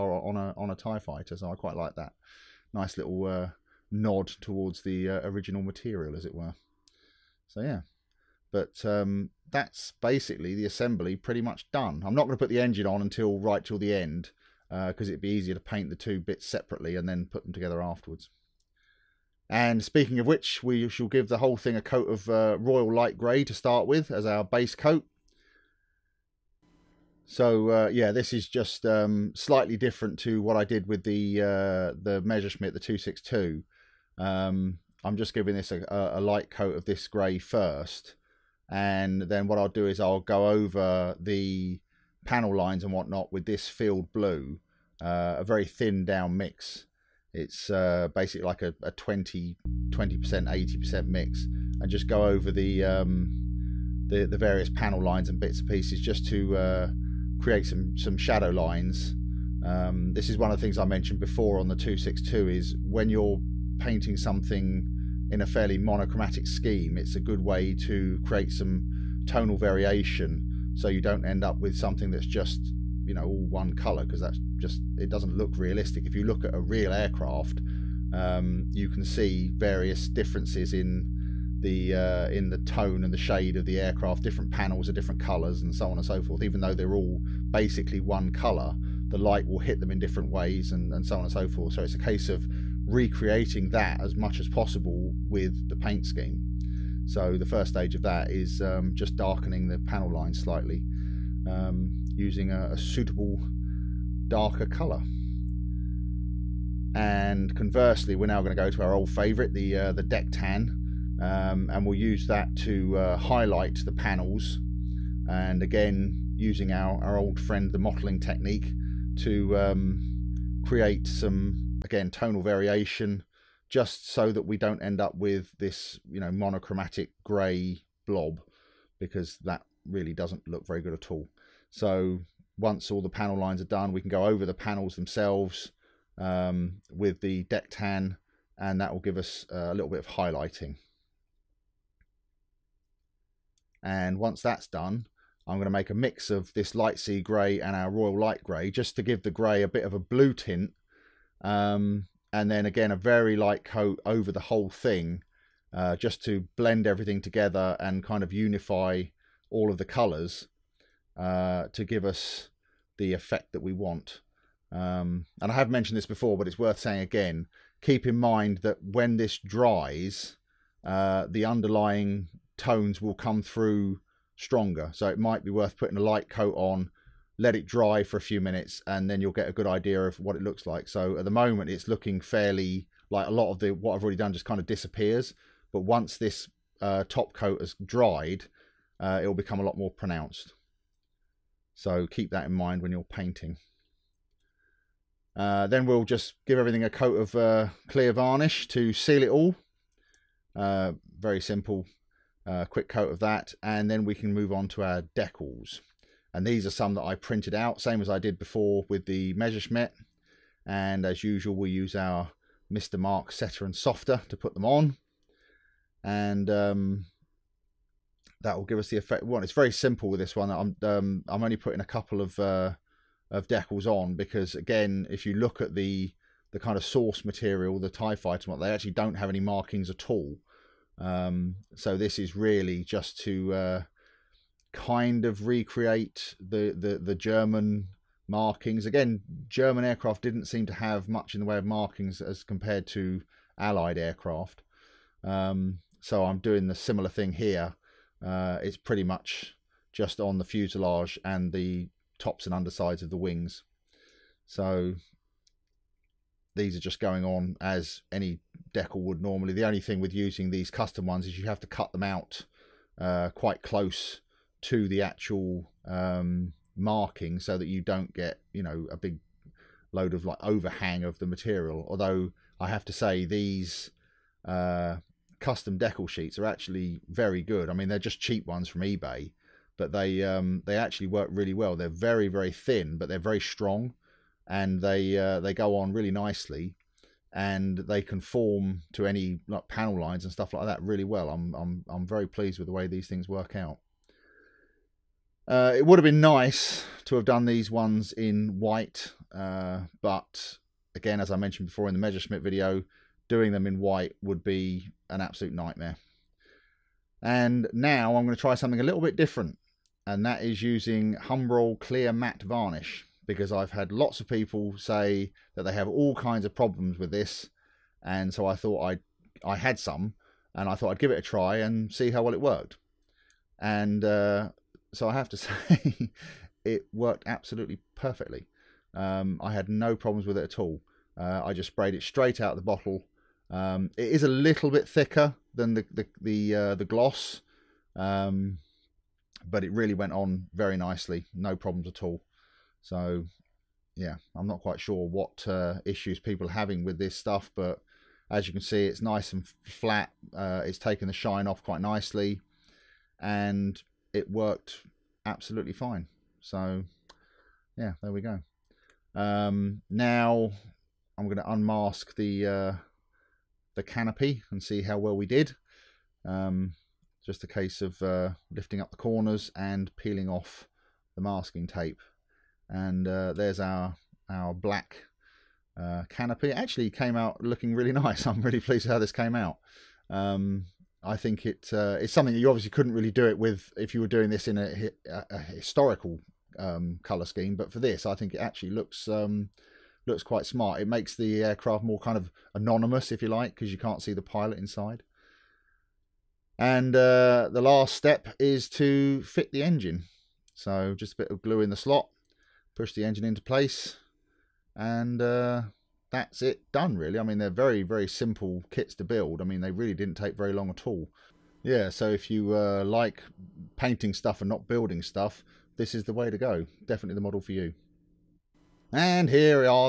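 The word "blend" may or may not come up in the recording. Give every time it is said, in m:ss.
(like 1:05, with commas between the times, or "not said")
2:36.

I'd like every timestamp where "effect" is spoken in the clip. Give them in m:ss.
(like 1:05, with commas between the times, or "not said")
2:43, 3:38.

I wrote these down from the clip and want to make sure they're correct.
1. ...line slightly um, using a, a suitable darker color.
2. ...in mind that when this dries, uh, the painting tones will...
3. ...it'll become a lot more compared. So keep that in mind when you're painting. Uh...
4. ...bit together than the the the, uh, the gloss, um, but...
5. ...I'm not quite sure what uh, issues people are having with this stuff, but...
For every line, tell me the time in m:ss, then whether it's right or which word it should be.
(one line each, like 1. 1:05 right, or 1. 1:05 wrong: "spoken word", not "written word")
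1. 1:40 right
2. 2:48 wrong: "underlying", not "painting"
3. 3:09 wrong: "pronounced", not "compared"
4. 5:34 wrong: "thicker", not "together"
5. 5:44 right.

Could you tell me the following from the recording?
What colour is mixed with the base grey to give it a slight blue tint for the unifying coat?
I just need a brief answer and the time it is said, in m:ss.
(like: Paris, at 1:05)
Light sea grey, at 2:26.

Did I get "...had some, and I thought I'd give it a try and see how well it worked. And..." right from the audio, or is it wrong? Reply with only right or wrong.
right.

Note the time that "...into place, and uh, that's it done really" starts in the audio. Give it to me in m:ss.
6:43.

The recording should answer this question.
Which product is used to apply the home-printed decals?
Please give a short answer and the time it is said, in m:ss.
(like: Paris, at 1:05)
Mr. Mark Setter and Softer, at 3:32.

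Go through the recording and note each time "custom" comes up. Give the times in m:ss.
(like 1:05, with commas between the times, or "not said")
4:20, 4:35.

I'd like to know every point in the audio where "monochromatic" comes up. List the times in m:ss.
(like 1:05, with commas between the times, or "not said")
1:05, 2:06.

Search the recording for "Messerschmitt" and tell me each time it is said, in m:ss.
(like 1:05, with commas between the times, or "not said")
0:32, 3:29, 5:01.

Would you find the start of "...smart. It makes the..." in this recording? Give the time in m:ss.
6:30.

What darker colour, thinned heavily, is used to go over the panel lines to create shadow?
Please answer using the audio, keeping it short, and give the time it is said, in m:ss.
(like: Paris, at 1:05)
Field blue, at 0:43.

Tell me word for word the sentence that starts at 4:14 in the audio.
So these are just going on as any decal would normally.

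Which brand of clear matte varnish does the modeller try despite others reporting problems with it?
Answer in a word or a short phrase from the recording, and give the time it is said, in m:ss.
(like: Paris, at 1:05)
Humbrol, at 5:11.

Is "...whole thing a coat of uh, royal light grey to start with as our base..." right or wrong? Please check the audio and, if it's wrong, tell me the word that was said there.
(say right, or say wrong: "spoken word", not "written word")
right.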